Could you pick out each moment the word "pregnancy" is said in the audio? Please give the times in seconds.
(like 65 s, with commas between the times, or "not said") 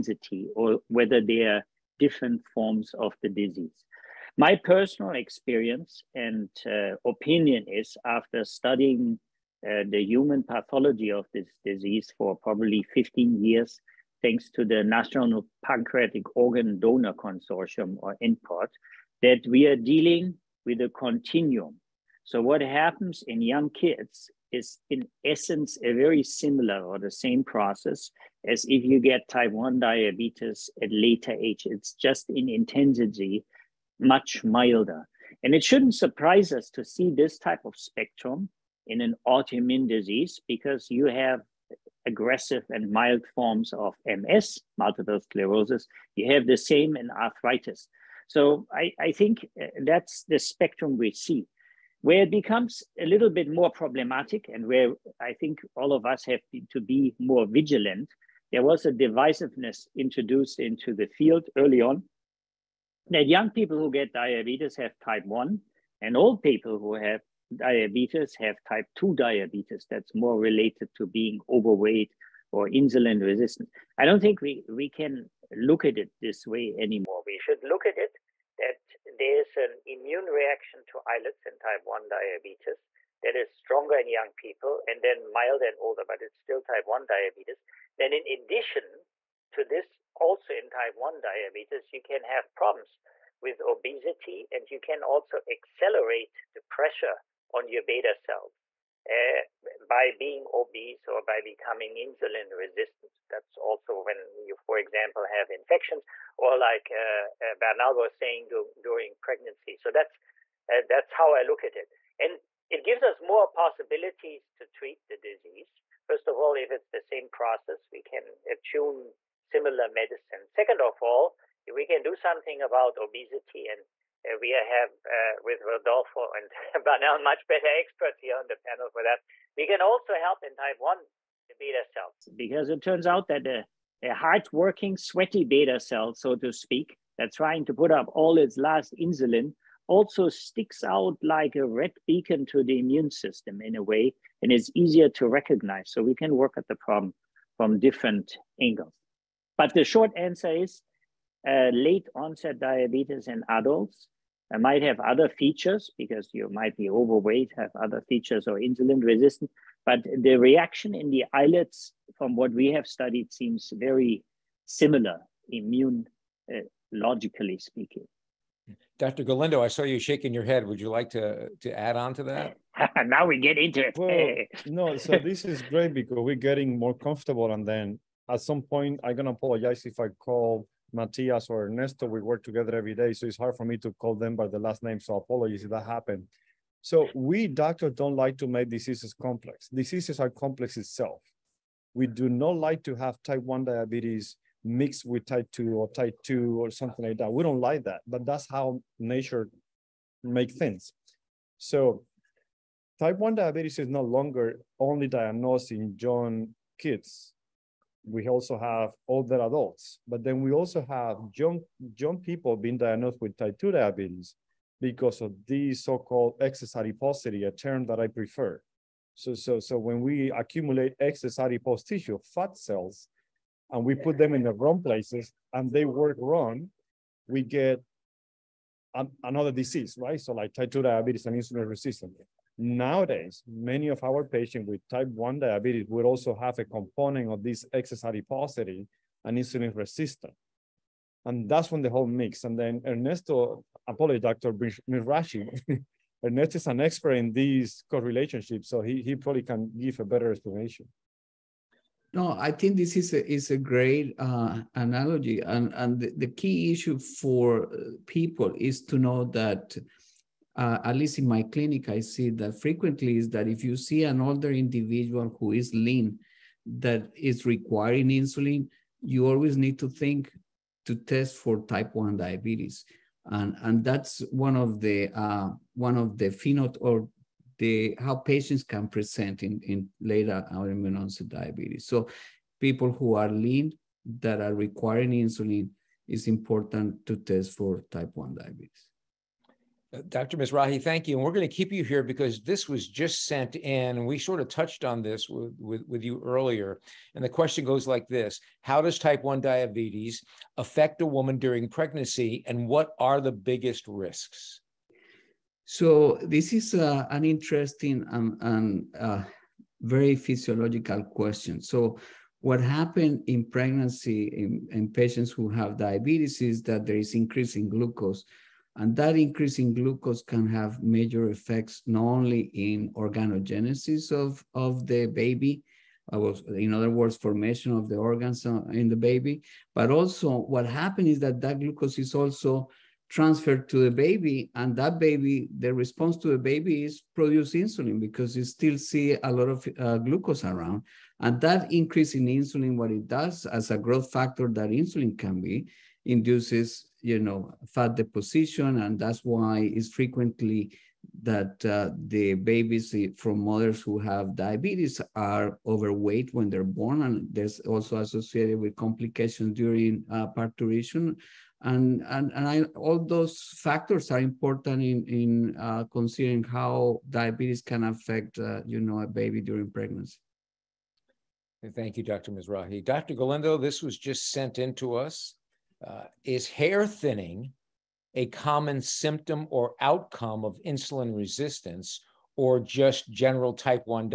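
109 s, 301 s, 313 s, 369 s.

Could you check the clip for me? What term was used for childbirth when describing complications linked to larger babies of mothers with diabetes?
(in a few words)
Parturition.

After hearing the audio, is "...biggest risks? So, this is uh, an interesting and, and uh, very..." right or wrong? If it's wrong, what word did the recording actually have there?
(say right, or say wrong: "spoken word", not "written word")
right.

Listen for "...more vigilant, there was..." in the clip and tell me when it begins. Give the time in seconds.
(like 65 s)
57 s.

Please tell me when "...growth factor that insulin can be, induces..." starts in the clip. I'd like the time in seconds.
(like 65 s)
343 s.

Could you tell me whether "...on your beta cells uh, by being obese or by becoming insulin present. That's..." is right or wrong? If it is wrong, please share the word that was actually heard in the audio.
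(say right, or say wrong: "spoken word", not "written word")
wrong: "resistant", not "present".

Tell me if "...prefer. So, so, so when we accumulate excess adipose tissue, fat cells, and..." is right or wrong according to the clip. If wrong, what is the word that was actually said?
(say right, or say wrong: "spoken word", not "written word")
right.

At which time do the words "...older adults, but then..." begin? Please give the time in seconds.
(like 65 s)
209 s.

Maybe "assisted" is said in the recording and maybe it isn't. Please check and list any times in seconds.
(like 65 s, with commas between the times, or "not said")
not said.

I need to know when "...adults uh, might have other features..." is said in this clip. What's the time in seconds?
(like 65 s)
153 s.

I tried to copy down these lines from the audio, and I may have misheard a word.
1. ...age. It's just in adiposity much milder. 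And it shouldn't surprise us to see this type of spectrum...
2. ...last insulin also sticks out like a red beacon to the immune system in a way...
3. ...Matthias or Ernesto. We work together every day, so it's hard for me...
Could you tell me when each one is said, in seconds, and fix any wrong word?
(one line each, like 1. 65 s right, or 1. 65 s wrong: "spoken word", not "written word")
1. 31 s wrong: "intensity", not "adiposity"
2. 138 s right
3. 180 s right.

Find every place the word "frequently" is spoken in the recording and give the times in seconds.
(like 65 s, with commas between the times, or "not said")
262 s, 349 s.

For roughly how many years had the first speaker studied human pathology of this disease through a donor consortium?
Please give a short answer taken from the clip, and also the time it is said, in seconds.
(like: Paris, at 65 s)
15 years, at 12 s.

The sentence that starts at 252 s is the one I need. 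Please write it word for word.
No, I think this is a, is a great uh, analogy.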